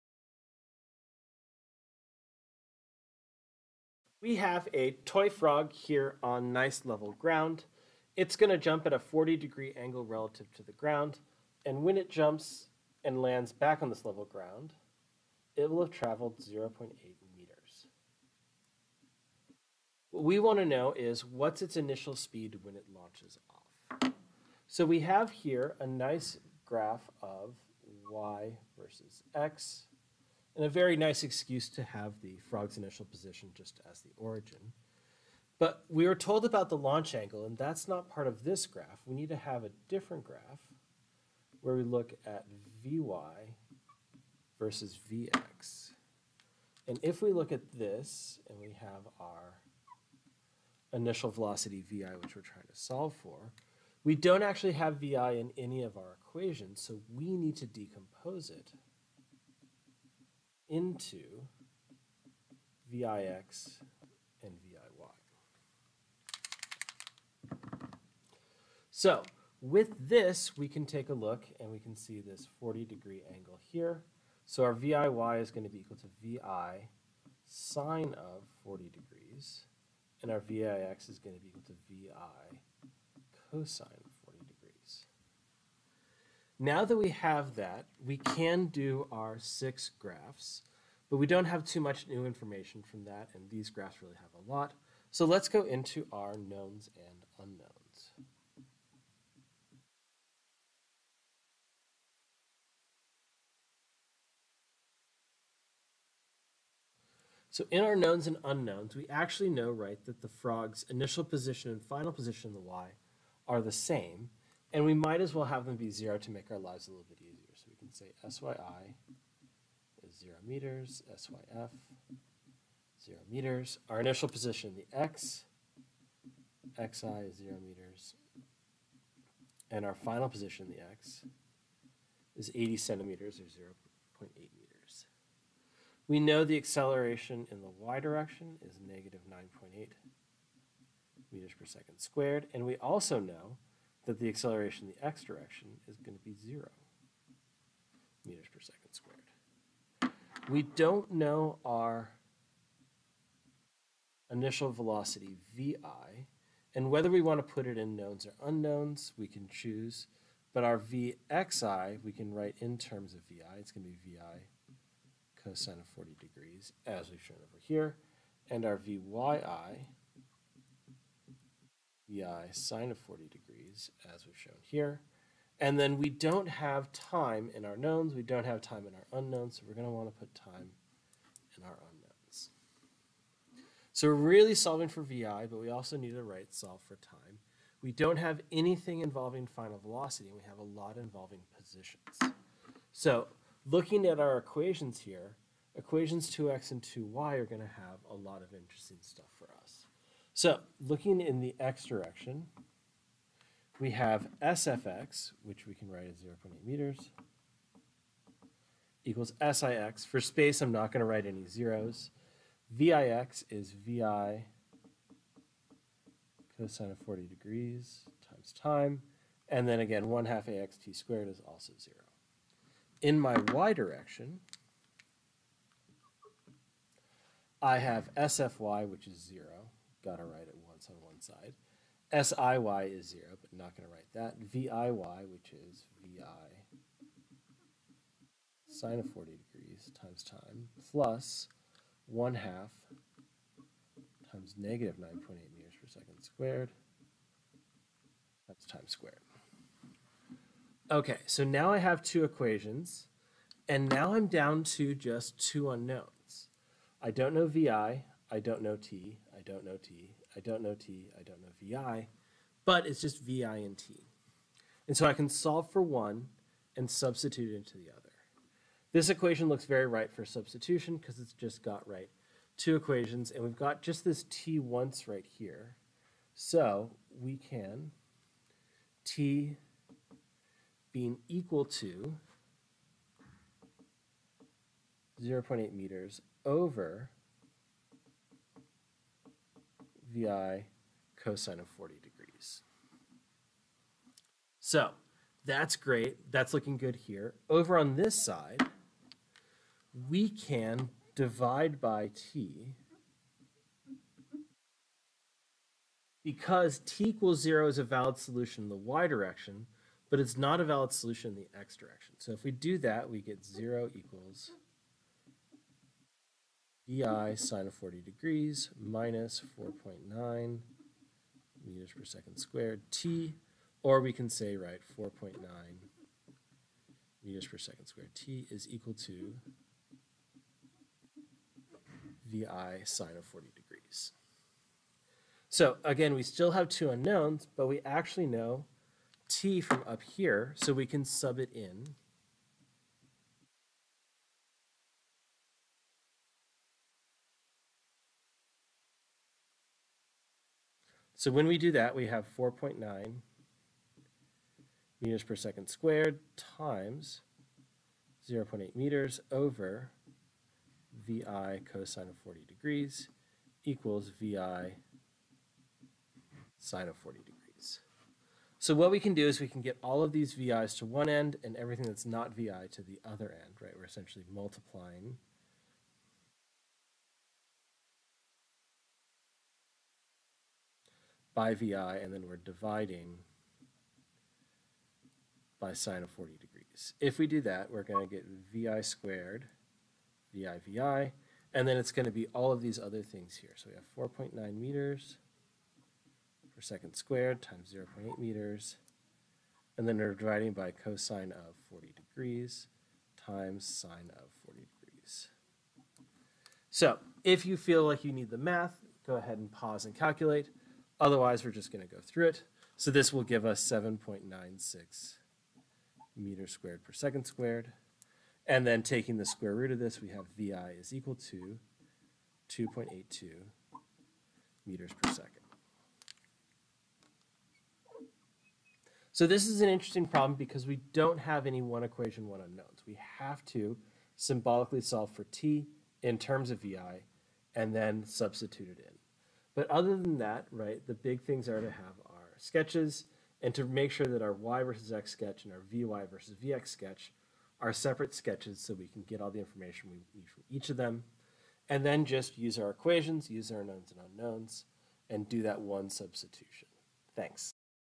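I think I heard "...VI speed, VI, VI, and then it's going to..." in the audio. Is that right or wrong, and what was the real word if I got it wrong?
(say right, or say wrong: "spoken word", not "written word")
wrong: "squared", not "speed".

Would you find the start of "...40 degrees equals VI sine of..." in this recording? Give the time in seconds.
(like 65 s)
362 s.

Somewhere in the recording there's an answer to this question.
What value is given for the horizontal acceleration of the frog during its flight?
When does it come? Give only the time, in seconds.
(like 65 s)
146 s.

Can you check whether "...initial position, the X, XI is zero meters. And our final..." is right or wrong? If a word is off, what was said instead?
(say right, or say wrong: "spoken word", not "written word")
right.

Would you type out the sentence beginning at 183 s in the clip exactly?
So we're really solving for vi, but we also need to write solve for time.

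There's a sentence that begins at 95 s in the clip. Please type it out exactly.
So let's go into our knowns and unknowns.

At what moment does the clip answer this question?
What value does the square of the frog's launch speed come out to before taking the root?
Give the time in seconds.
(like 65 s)
413 s.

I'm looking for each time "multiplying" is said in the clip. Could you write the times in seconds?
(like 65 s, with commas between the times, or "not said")
374 s.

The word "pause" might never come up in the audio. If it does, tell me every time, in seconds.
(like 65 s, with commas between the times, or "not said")
409 s.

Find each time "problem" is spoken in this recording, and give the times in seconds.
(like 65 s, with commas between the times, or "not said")
430 s.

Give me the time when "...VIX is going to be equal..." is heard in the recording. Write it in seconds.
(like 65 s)
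80 s.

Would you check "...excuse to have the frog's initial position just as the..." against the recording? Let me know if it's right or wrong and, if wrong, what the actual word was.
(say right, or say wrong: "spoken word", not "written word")
right.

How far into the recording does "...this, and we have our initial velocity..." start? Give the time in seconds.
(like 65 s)
47 s.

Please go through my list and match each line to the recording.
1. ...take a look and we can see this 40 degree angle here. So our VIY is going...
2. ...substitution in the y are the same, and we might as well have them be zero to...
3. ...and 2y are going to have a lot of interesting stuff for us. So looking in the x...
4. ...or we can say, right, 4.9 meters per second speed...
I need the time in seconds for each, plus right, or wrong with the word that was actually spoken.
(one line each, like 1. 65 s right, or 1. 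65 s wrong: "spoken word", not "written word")
1. 70 s right
2. 112 s wrong: "position", not "substitution"
3. 196 s right
4. 323 s wrong: "squared", not "speed".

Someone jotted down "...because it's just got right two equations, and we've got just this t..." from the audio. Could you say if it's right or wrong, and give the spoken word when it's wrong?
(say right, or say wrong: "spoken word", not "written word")
right.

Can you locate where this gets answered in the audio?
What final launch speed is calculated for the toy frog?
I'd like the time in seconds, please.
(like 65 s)
422 s.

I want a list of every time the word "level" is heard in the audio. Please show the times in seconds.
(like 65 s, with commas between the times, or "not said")
6 s, 14 s.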